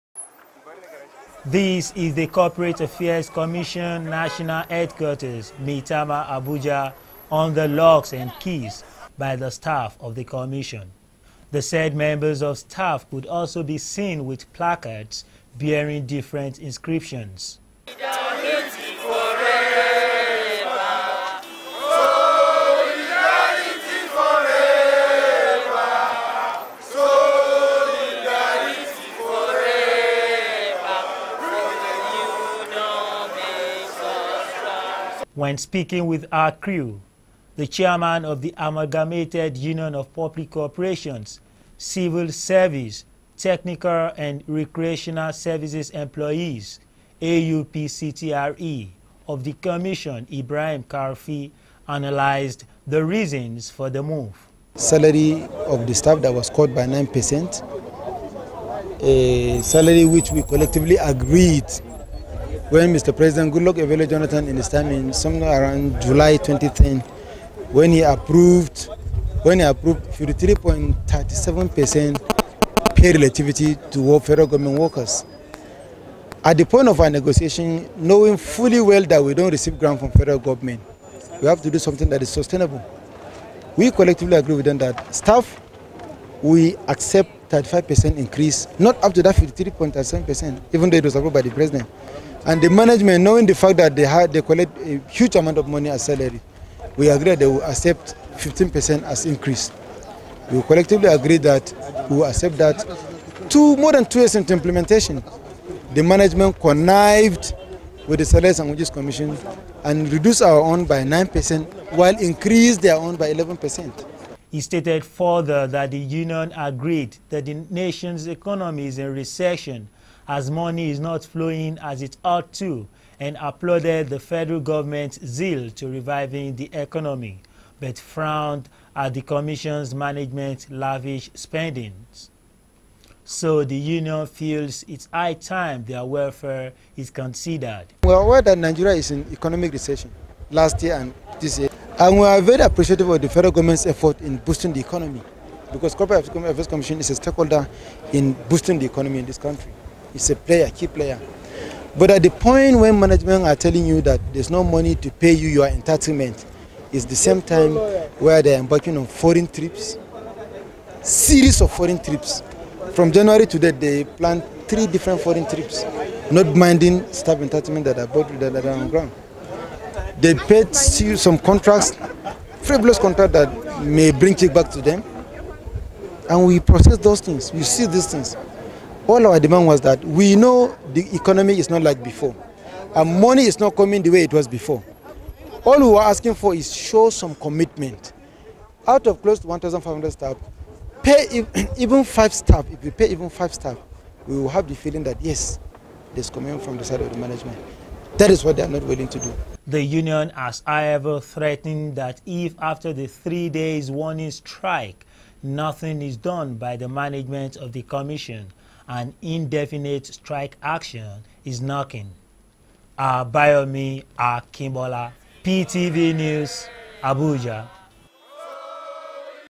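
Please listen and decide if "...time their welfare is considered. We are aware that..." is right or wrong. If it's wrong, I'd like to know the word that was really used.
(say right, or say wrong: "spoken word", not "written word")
right.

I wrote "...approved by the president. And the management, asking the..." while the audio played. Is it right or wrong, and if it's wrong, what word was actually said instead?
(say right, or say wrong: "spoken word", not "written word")
wrong: "knowing", not "asking".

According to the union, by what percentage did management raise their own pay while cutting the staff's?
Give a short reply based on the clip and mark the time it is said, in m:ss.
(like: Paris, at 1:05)
11%, at 1:53.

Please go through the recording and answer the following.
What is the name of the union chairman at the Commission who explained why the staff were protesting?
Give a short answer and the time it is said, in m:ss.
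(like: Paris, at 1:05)
Ibrahim Karfi, at 0:50.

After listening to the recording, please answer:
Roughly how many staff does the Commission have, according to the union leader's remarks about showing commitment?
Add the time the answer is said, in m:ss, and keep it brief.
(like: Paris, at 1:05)
1,500, at 3:09.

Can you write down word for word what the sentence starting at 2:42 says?
From January to date, they planned three different foreign trips, not minding staff entitlement that are bought that are on ground.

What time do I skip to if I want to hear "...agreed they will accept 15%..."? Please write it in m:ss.
1:37.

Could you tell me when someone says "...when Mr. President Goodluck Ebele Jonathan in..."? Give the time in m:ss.
1:02.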